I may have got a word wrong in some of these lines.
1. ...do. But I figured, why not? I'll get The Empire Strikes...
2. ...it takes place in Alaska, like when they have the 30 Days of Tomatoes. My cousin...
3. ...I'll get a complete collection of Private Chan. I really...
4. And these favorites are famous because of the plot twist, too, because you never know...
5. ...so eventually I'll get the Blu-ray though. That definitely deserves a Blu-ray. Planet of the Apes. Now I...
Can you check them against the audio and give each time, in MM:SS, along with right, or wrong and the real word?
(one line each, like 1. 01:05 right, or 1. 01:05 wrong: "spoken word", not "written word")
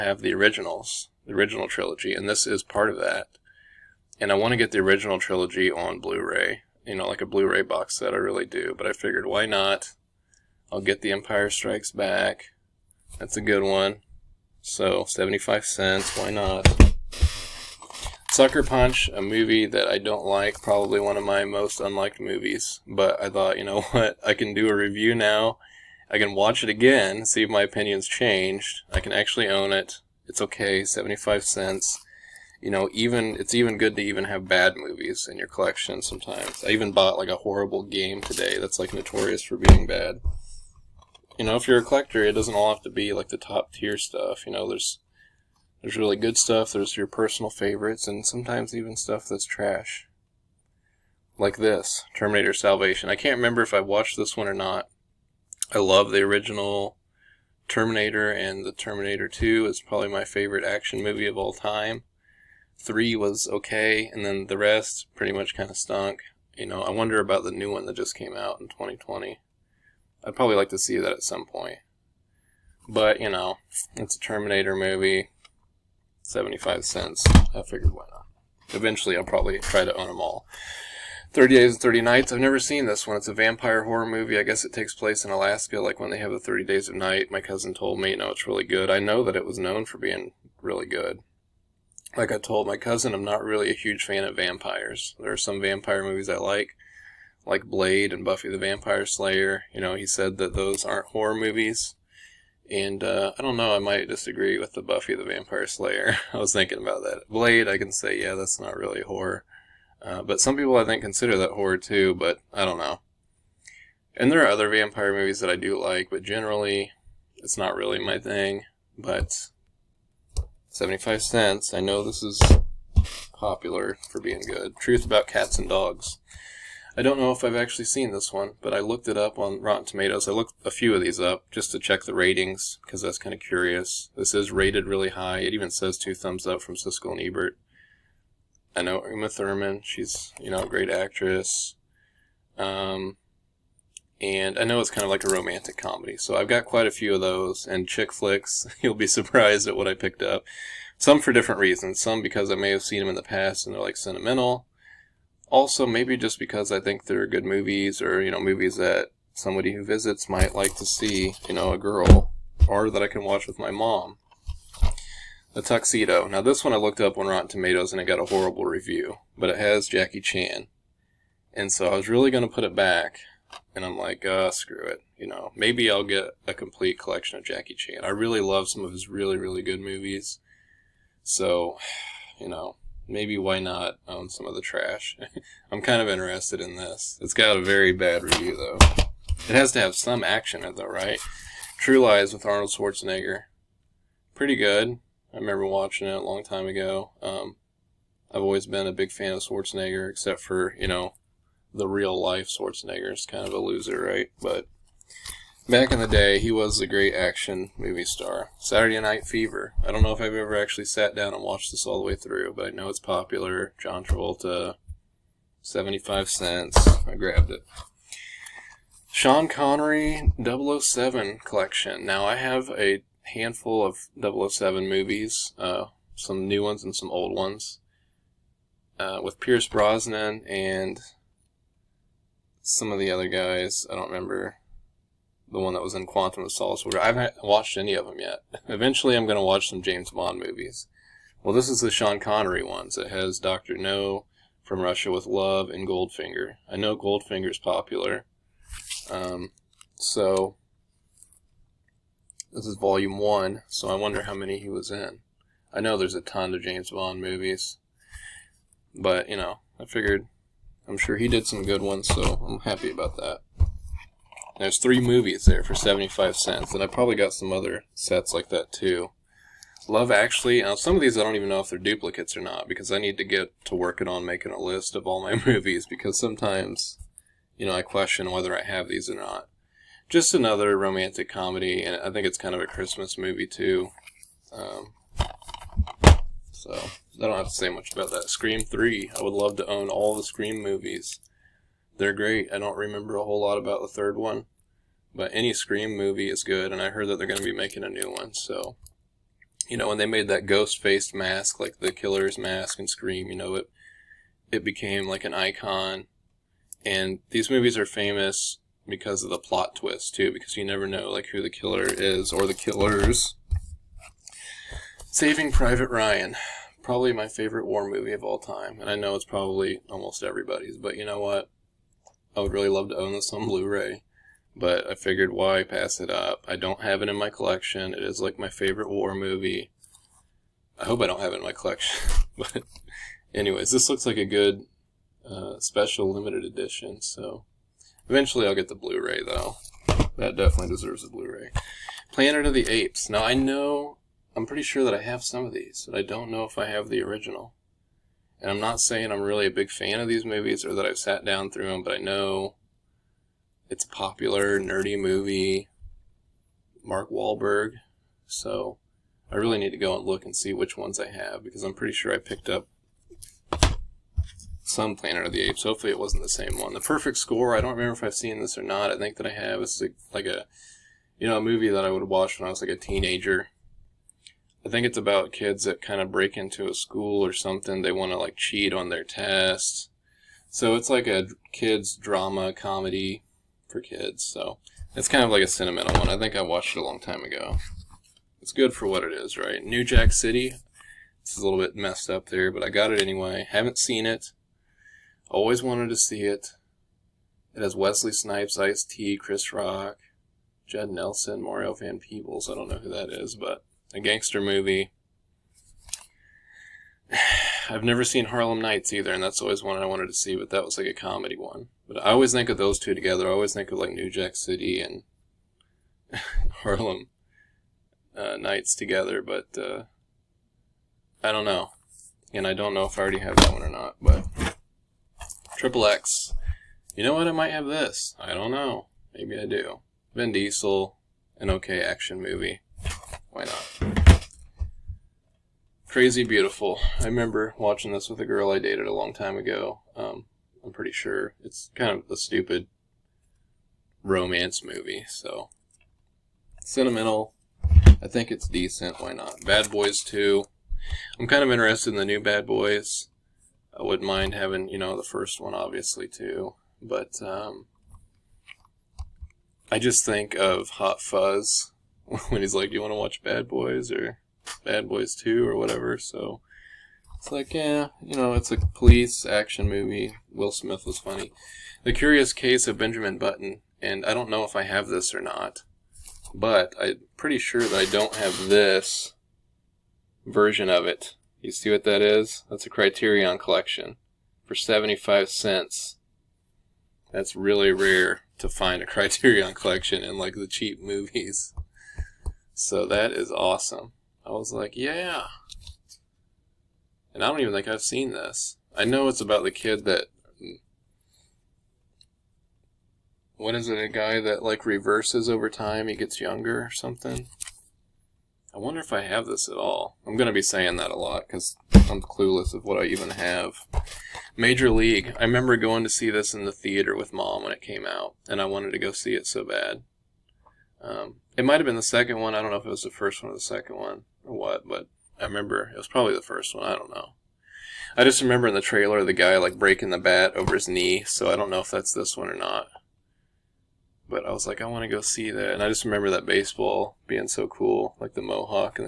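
1. 00:08 right
2. 01:24 wrong: "Night", not "Tomatoes"
3. 02:55 wrong: "Jackie", not "Private"
4. 05:06 wrong: "movies", not "favorites"
5. 05:37 right.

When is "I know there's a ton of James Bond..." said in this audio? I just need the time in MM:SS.
04:15.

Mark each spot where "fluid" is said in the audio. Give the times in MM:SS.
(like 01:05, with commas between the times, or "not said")
not said.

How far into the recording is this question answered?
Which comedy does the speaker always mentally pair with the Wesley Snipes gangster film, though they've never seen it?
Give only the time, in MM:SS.
06:48.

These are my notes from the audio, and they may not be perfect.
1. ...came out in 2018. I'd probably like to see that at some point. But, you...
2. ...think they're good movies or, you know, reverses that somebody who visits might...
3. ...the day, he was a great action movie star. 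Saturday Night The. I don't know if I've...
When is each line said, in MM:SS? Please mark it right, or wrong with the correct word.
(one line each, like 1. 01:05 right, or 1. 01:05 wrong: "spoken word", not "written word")
1. 01:08 wrong: "2020", not "2018"
2. 02:36 wrong: "movies", not "reverses"
3. 03:26 wrong: "Fever", not "The".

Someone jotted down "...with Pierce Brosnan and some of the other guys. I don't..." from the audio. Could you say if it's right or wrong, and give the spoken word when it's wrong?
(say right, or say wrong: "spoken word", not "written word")
right.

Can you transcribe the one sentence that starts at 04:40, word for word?
Just another romantic comedy, and I think it's kind of a Christmas movie too.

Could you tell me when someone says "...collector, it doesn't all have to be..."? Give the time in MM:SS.
00:41.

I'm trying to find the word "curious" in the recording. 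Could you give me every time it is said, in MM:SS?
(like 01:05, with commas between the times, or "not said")
02:13, 07:51.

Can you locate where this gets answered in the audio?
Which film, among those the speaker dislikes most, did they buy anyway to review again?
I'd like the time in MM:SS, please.
00:18.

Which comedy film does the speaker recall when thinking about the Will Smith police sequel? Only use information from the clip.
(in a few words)
Hot Fuzz.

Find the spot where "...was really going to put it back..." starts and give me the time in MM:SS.
02:51.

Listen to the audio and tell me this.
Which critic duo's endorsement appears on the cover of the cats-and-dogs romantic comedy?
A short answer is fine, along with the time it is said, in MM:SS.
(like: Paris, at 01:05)
Siskel and Ebert, at 02:16.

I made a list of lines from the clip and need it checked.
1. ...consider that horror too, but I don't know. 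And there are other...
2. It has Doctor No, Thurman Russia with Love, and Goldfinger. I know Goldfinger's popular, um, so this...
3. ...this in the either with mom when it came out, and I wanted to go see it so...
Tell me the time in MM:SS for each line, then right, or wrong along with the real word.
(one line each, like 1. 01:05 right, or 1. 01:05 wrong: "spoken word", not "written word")
1. 01:51 right
2. 04:02 wrong: "From", not "Thurman"
3. 08:36 wrong: "theater", not "either".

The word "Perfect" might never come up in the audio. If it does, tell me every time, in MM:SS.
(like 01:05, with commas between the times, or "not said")
06:06.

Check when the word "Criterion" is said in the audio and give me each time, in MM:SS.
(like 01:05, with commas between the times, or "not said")
08:02, 08:08.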